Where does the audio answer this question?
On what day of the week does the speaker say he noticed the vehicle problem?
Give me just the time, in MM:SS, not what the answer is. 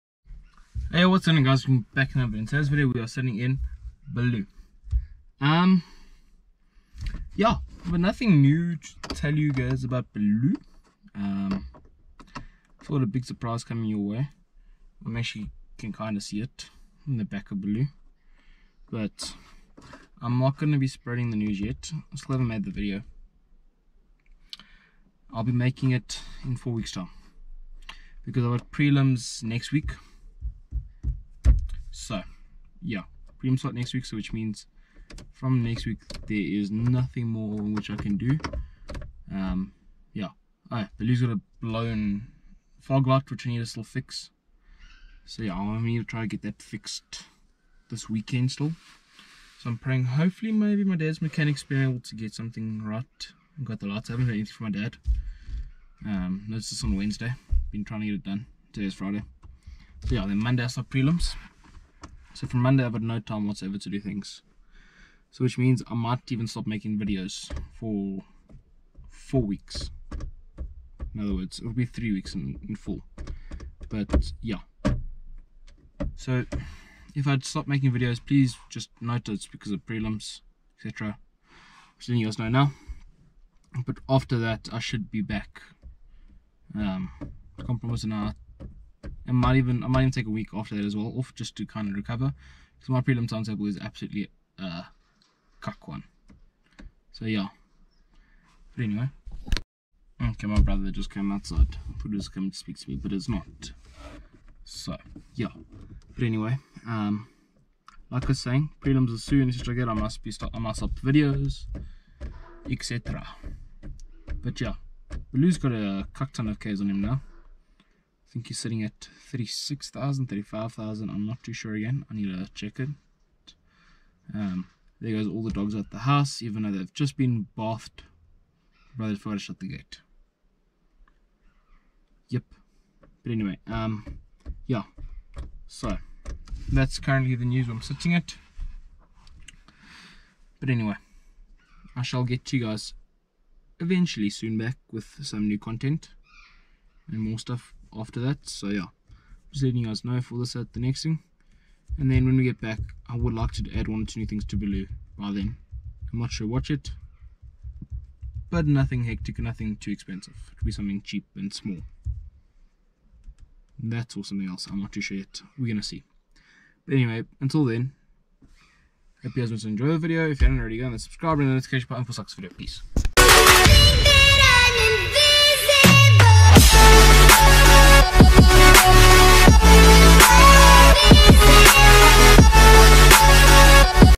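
00:56.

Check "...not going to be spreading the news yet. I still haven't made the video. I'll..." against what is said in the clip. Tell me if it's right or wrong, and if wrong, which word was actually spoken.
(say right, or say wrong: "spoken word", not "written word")
right.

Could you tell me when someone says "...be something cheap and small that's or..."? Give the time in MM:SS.
02:40.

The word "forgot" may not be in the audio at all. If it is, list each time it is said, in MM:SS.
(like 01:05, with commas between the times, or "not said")
02:09.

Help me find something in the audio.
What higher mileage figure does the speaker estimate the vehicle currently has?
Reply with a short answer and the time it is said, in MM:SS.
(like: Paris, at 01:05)
36,000, at 01:59.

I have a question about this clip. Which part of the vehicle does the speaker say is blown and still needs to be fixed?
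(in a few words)
fog light.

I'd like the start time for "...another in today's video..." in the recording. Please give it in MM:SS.
00:02.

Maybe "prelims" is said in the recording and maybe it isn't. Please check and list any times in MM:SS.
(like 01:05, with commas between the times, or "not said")
00:28, 01:00, 01:19, 01:32, 01:48.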